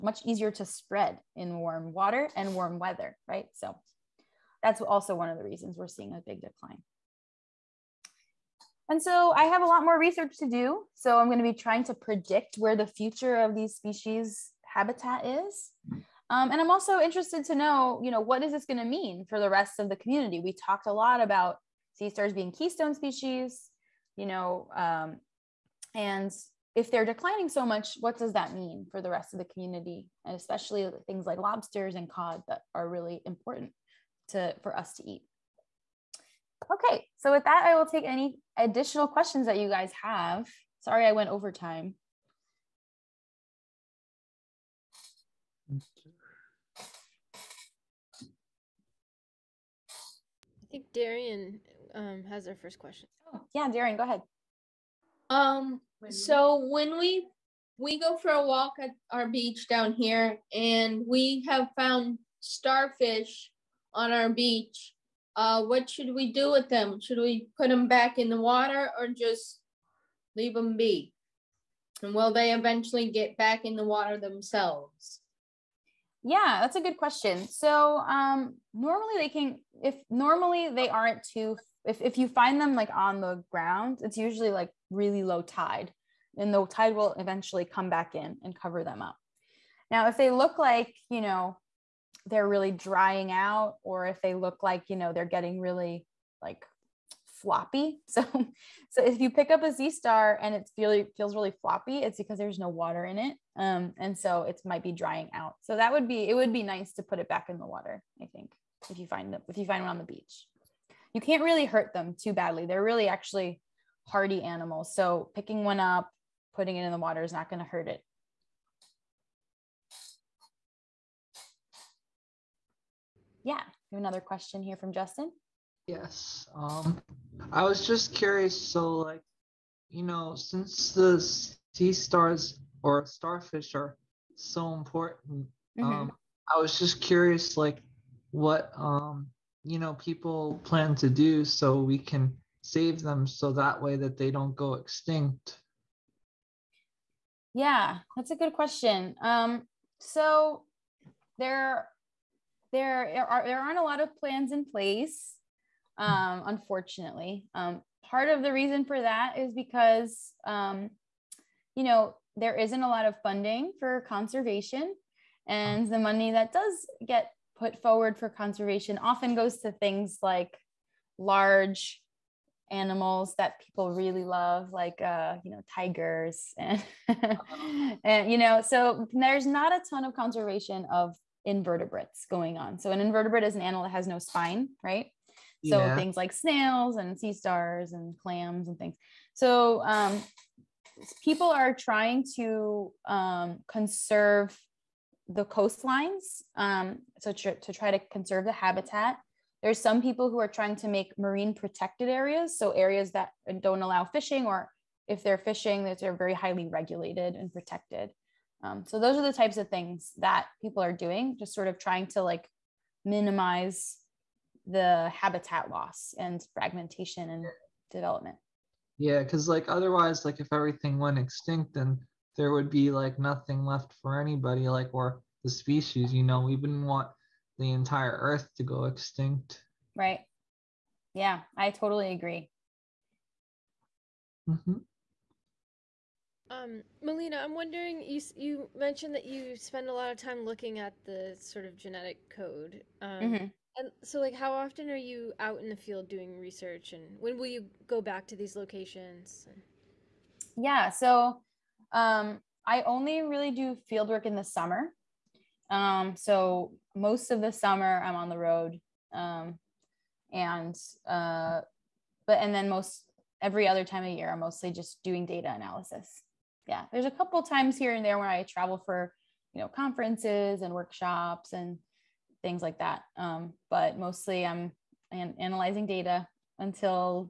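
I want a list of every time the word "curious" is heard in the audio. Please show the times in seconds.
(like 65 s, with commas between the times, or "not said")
128 s, 137 s.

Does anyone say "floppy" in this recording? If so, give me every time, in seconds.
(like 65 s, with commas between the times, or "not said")
97 s, 101 s.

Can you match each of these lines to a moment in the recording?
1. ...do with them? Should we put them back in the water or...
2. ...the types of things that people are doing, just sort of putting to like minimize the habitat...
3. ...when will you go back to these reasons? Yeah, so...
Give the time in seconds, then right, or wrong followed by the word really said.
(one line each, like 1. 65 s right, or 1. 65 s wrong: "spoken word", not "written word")
1. 66 s right
2. 209 s wrong: "trying", not "putting"
3. 247 s wrong: "locations", not "reasons".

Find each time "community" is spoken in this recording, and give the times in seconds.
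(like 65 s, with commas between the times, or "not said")
19 s, 29 s.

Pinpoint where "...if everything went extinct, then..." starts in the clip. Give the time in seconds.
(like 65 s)
220 s.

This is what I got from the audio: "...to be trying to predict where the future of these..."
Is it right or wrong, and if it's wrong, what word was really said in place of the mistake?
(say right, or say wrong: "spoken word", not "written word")
right.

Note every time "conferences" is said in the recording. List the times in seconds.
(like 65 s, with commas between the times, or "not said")
269 s.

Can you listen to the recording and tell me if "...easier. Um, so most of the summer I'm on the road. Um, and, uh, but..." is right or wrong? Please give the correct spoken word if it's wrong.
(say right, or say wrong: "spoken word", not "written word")
wrong: "summer", not "easier".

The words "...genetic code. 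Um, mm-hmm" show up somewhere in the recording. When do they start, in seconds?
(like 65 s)
241 s.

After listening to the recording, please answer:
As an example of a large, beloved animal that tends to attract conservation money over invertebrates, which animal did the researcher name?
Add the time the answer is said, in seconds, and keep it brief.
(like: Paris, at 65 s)
Tigers, at 175 s.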